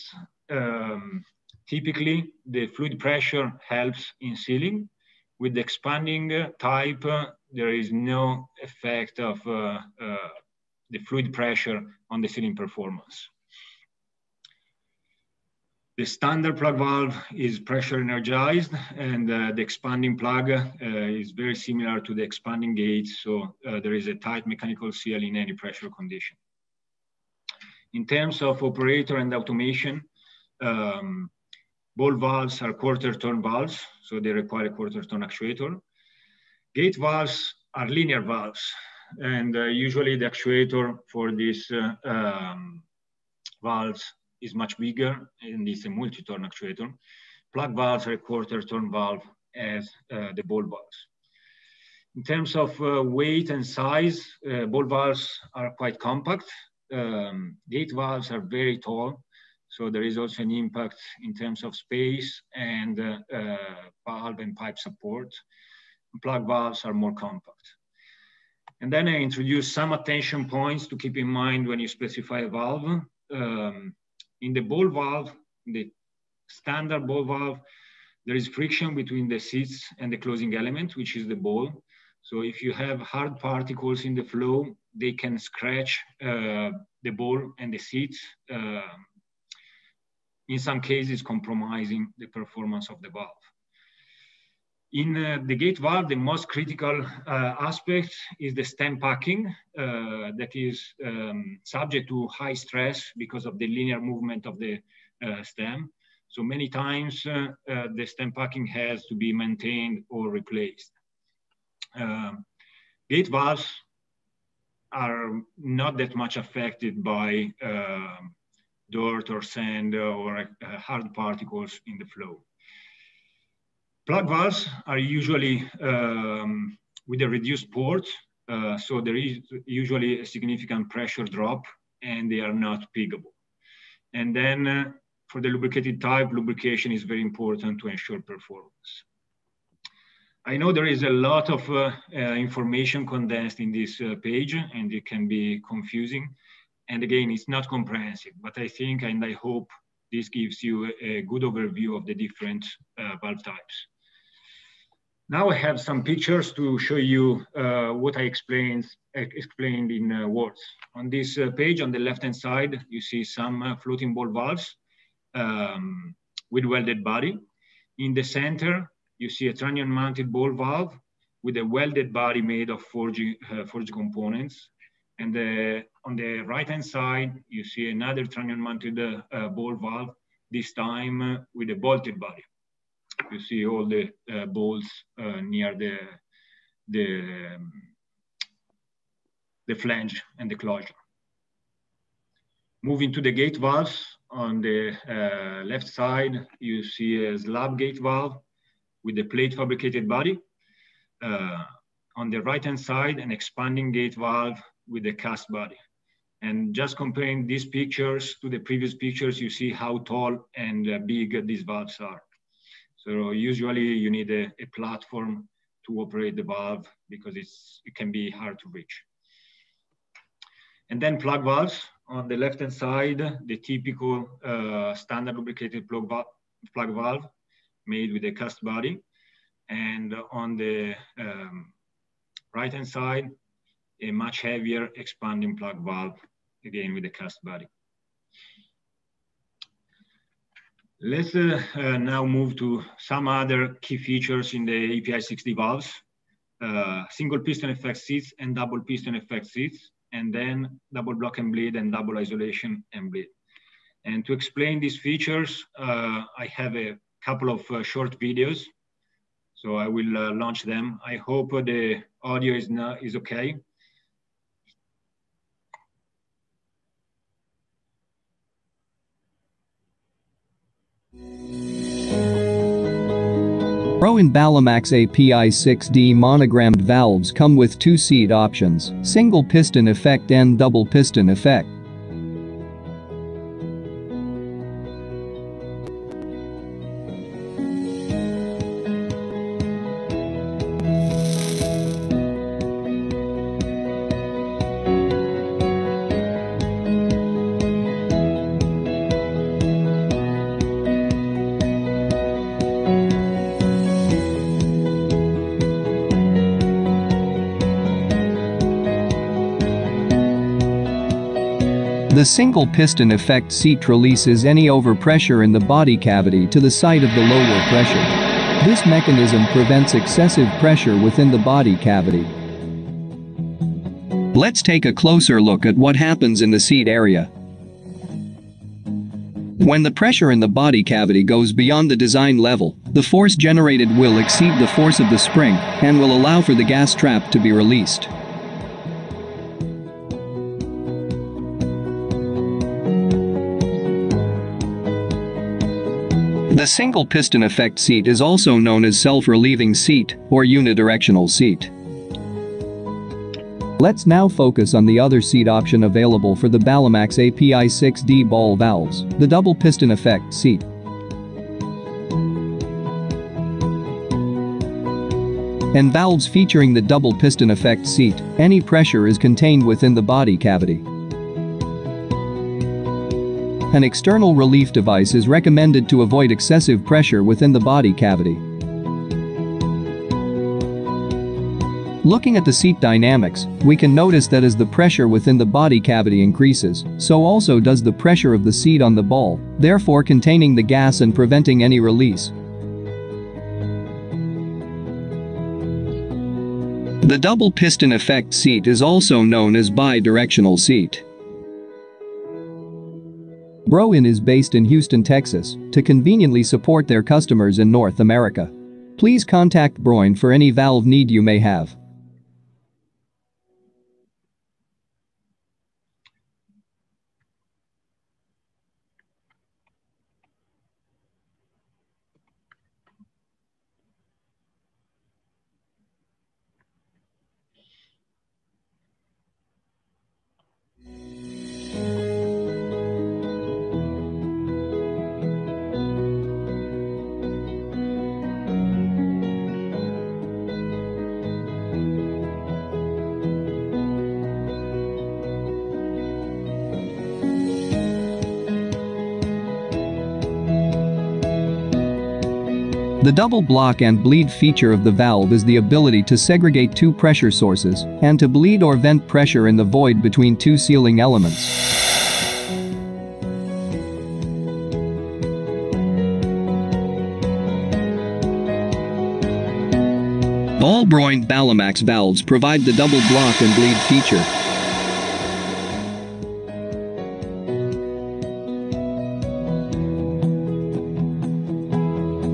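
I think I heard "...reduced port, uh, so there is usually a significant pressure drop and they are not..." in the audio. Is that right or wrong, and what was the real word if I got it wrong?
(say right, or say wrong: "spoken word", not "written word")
right.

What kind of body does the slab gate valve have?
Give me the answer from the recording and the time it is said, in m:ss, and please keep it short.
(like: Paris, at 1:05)
plate fabricated body, at 3:19.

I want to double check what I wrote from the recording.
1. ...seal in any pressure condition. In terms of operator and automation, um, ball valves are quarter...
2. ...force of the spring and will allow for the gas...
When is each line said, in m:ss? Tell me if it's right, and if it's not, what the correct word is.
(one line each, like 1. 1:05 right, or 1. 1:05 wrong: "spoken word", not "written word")
1. 0:24 right
2. 5:34 right.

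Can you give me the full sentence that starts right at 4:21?
I hope uh, the audio is, not, is okay.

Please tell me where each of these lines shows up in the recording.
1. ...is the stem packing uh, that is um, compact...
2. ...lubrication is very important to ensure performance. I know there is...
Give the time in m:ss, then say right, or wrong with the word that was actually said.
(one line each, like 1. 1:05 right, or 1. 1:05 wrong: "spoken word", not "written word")
1. 1:38 wrong: "subject", not "compact"
2. 2:16 right.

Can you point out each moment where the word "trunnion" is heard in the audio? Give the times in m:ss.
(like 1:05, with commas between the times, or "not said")
2:49, 2:58.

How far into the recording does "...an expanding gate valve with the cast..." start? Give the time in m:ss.
3:23.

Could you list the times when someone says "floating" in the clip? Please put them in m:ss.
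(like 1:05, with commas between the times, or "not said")
2:43.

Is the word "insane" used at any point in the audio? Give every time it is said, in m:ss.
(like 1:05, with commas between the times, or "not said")
not said.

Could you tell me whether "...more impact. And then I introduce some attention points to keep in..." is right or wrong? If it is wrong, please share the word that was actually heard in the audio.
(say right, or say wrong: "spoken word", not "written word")
wrong: "compact", not "impact".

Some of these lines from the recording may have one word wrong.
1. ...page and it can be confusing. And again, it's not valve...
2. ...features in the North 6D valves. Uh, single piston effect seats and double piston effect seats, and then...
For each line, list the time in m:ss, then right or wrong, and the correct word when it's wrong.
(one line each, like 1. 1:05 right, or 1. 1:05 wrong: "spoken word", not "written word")
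1. 2:24 wrong: "comprehensive", not "valve"
2. 4:03 wrong: "API", not "North".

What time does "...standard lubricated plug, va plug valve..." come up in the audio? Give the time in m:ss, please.
3:44.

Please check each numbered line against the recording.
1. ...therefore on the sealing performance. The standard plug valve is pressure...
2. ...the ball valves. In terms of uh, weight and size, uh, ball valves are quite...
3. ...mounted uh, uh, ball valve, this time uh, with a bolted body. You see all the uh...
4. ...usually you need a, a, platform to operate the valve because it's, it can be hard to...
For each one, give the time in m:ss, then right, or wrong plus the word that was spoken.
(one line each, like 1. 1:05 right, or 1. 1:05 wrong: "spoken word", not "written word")
1. 0:11 wrong: "pressure", not "therefore"
2. 0:50 right
3. 2:58 right
4. 3:33 right.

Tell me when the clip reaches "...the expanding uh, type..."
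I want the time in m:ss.
0:05.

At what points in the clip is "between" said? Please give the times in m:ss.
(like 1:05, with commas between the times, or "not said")
1:18, 7:40.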